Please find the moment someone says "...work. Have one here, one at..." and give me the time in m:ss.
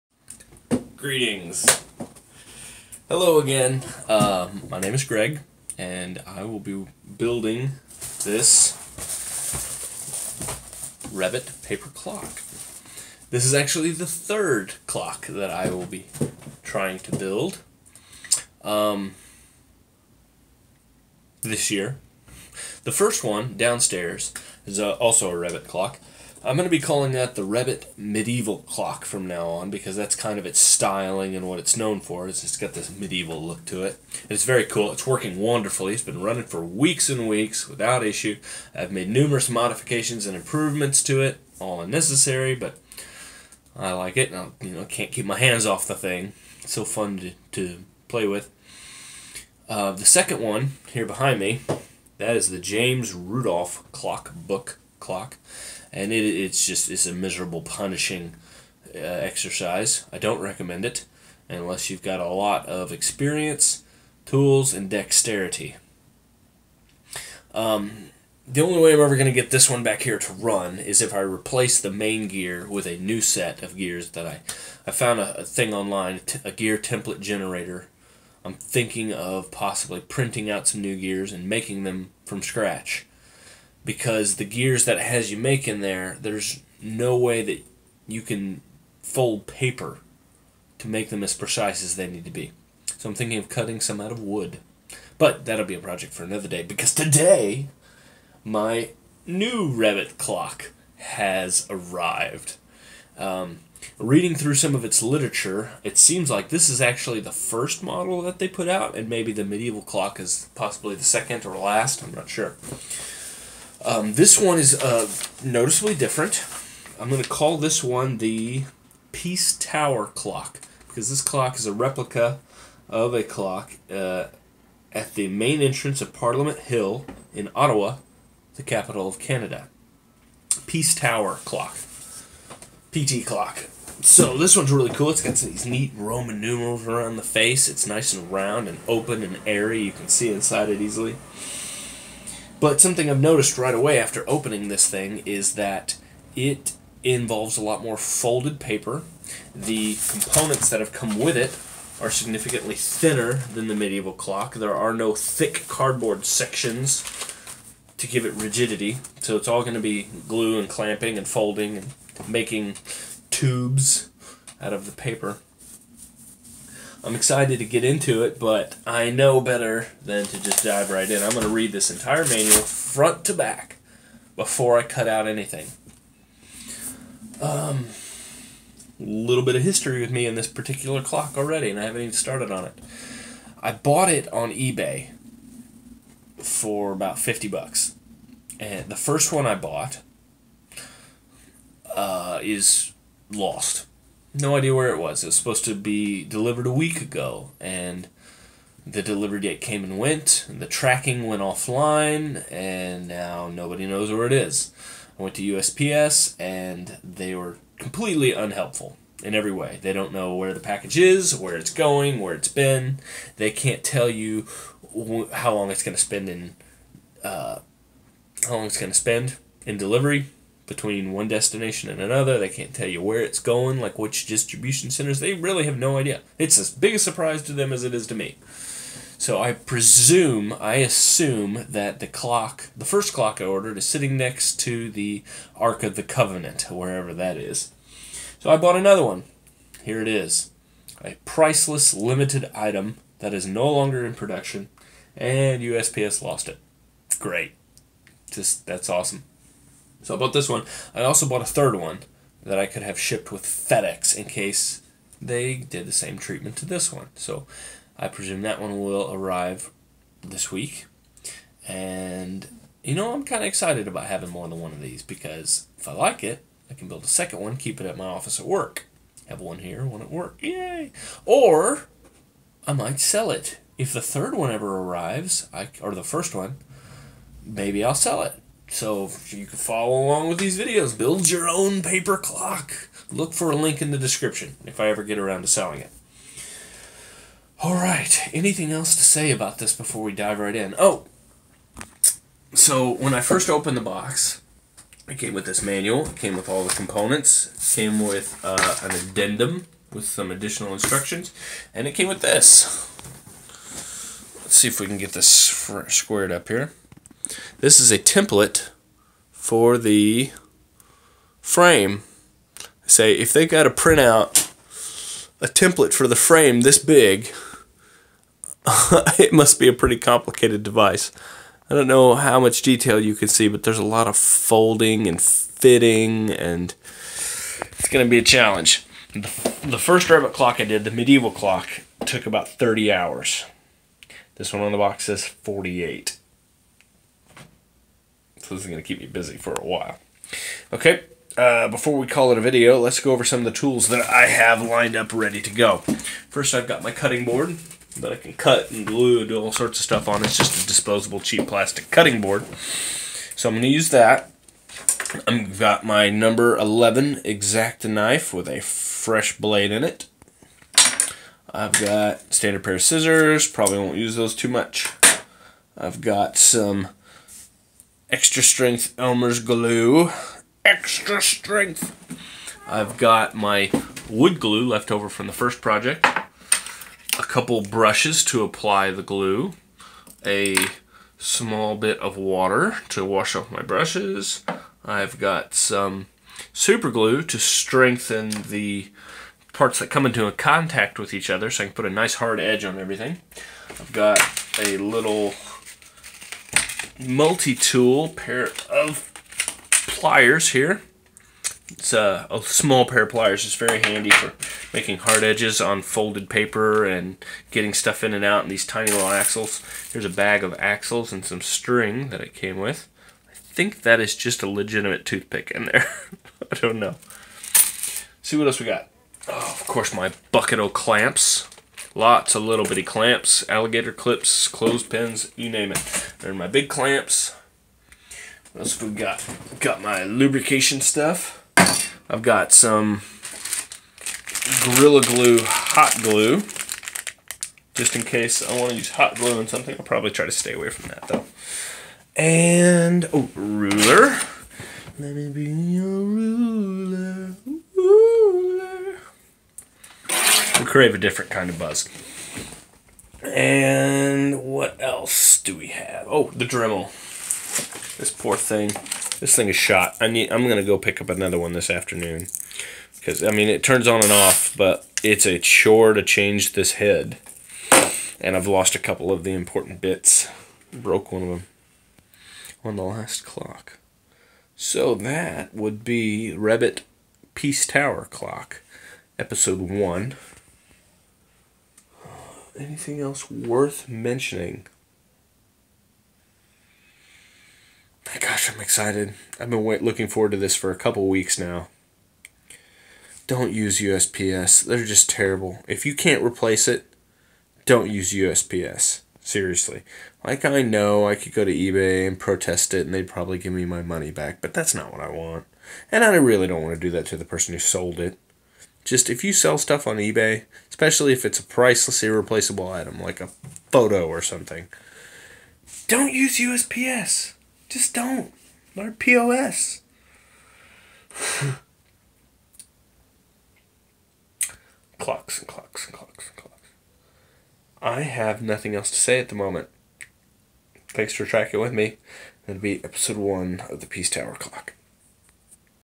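4:28.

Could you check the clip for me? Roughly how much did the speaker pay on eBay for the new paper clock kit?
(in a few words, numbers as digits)
50 bucks.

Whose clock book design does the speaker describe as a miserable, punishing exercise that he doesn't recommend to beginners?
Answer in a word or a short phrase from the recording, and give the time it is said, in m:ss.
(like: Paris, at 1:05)
James Rudolph, at 0:52.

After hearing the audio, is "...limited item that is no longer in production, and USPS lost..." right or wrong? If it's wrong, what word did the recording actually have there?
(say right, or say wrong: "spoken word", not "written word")
right.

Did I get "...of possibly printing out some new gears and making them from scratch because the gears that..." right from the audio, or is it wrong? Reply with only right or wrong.
right.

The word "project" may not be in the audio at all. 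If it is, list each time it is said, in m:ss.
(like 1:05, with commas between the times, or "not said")
1:35, 6:15.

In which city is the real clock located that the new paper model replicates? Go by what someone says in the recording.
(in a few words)
Ottawa.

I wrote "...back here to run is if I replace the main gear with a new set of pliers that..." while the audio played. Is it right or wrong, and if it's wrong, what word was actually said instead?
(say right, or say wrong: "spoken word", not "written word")
wrong: "gears", not "pliers".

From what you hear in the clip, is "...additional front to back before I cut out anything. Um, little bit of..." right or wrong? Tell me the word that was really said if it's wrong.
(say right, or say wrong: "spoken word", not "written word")
wrong: "manual", not "additional".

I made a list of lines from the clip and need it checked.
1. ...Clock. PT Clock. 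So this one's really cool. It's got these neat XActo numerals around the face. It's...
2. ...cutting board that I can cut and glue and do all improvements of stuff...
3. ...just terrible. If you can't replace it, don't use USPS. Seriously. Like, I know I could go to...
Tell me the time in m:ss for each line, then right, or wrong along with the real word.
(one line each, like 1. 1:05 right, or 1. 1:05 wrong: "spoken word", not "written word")
1. 2:11 wrong: "Roman", not "XActo"
2. 5:46 wrong: "sorts", not "improvements"
3. 8:14 right.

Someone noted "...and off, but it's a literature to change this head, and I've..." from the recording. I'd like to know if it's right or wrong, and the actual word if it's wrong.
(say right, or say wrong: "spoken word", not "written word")
wrong: "chore", not "literature".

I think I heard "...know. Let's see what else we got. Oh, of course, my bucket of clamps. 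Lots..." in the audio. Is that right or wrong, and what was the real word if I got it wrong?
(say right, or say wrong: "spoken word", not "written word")
right.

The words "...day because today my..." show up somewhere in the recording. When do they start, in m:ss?
1:36.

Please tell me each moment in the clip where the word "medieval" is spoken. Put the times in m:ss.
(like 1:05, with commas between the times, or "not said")
0:27, 0:32, 1:49, 2:33, 5:30.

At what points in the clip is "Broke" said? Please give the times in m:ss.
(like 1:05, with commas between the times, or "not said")
7:50.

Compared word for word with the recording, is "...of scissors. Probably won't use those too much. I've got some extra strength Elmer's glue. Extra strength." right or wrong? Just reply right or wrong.
right.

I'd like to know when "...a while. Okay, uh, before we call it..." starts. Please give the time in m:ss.
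5:39.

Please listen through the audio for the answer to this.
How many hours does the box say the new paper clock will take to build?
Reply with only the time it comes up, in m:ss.
5:35.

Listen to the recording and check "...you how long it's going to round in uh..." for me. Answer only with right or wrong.
wrong.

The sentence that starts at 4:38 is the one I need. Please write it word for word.
So you can follow along with these videos.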